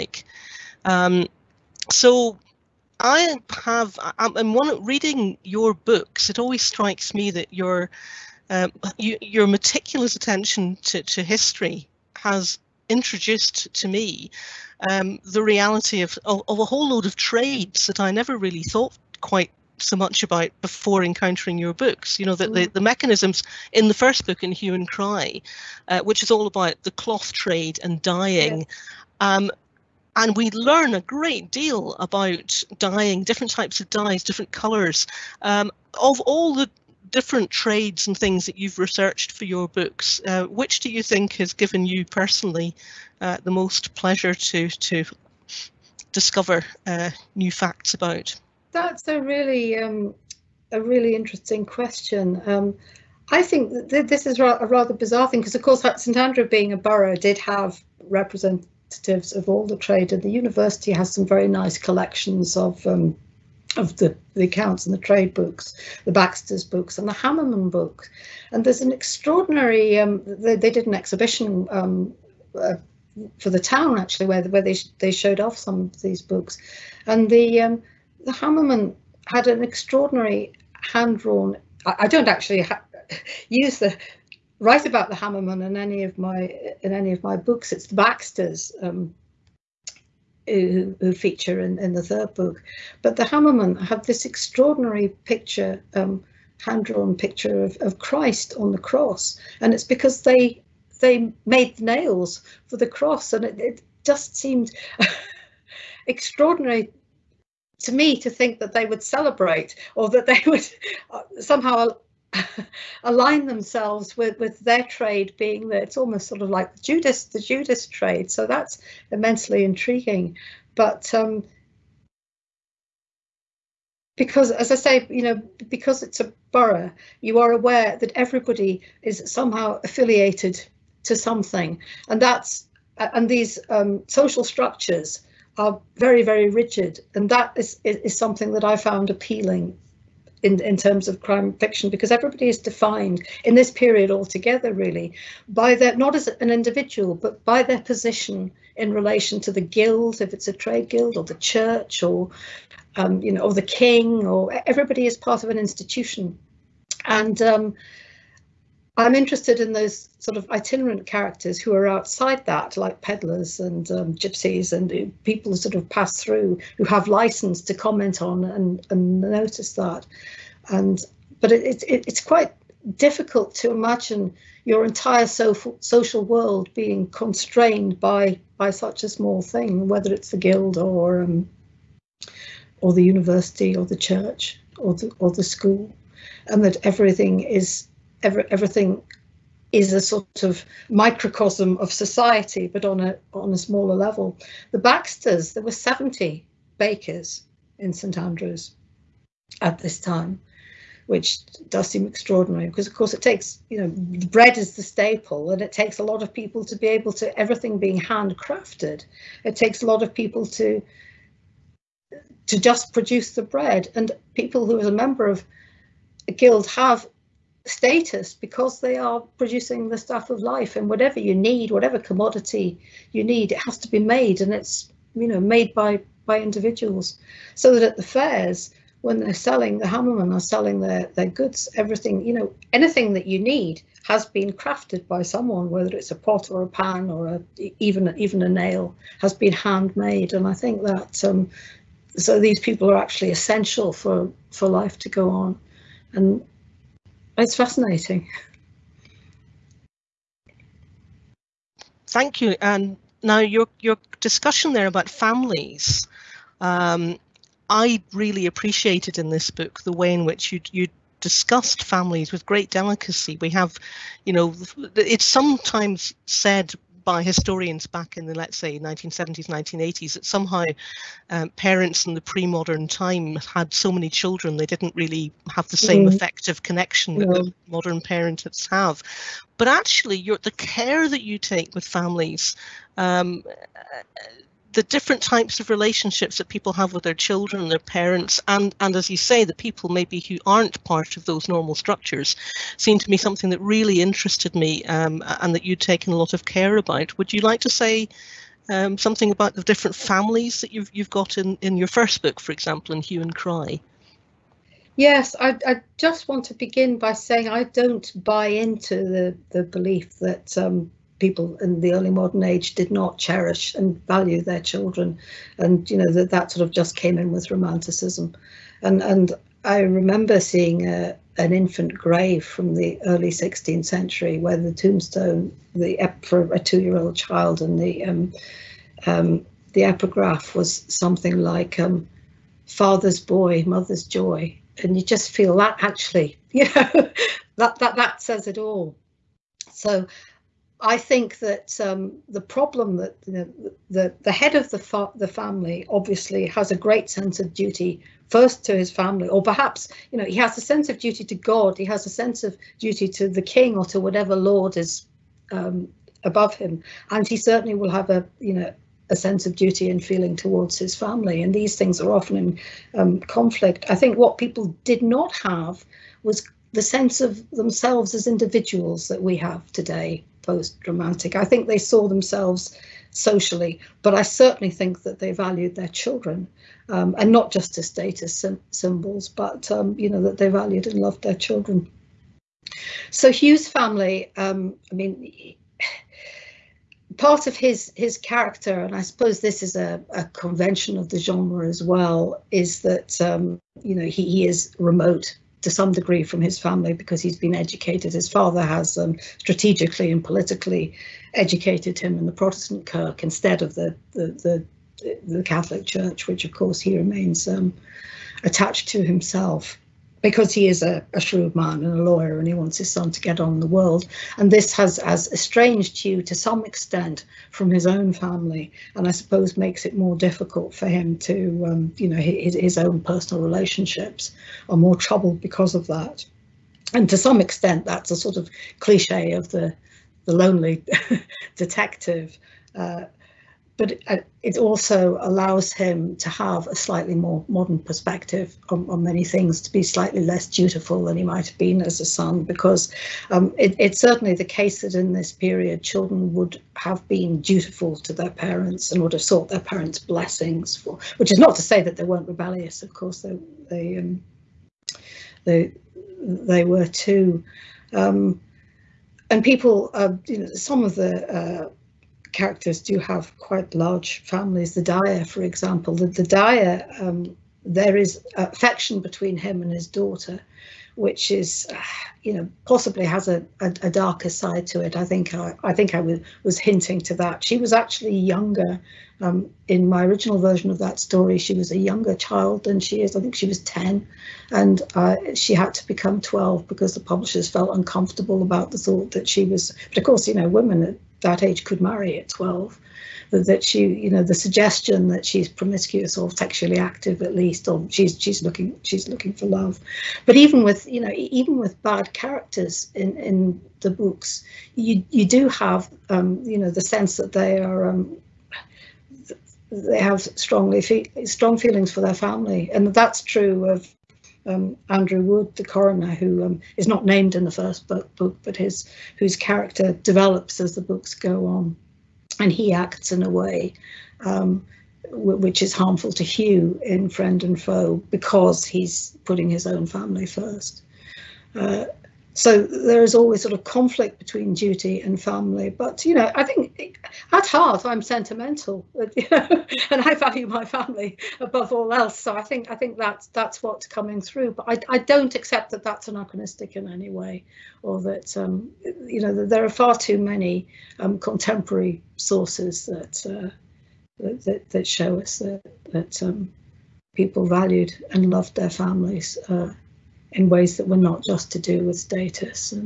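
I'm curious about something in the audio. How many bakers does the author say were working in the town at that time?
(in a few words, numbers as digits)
70.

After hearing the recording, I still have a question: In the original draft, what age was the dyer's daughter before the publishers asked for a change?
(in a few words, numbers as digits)
10.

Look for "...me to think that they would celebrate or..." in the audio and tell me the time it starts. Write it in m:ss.
1:47.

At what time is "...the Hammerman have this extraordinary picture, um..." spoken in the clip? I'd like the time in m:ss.
1:33.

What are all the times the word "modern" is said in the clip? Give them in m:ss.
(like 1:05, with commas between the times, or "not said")
4:32, 4:37, 5:12, 7:17.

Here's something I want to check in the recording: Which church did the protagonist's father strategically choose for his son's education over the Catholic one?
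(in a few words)
Protestant Kirk.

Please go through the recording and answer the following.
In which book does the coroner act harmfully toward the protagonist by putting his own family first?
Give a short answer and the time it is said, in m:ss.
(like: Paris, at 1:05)
Friend and Foe, at 8:47.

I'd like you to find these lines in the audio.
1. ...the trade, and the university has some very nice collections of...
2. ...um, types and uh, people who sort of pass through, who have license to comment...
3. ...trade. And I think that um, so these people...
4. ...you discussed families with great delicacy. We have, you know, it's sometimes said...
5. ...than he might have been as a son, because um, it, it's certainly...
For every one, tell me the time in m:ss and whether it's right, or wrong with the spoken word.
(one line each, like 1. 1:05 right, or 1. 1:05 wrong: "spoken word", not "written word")
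1. 0:59 right
2. 2:43 wrong: "gypsies", not "types"
3. 3:59 wrong: "handmade", not "trade"
4. 4:20 right
5. 7:21 right.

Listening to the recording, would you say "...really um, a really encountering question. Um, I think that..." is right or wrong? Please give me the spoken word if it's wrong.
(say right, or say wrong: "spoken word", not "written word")
wrong: "interesting", not "encountering".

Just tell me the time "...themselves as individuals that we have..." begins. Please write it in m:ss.
6:07.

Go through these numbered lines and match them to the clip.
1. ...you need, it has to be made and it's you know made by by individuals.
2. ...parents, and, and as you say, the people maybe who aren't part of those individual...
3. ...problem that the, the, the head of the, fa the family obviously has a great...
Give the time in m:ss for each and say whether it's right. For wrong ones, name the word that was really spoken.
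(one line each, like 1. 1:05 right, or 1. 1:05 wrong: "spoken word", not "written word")
1. 3:43 right
2. 4:47 wrong: "normal", not "individual"
3. 5:42 right.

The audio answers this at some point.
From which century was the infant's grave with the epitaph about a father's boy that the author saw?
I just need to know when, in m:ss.
5:23.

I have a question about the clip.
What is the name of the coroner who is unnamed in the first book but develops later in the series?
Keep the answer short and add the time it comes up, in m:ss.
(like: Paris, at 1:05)
Andrew Wood, at 8:34.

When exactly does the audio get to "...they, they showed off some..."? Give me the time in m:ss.
1:14.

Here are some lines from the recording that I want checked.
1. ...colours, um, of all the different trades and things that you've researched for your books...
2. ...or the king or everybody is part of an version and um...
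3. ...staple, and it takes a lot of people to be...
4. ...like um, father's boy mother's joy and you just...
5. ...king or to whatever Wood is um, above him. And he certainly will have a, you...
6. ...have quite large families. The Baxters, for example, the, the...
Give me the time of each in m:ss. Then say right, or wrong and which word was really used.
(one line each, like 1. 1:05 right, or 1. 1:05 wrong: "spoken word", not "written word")
1. 0:34 right
2. 2:33 wrong: "institution", not "version"
3. 3:24 right
4. 5:31 right
5. 5:53 wrong: "Lord", not "Wood"
6. 7:42 wrong: "Dyer", not "Baxters".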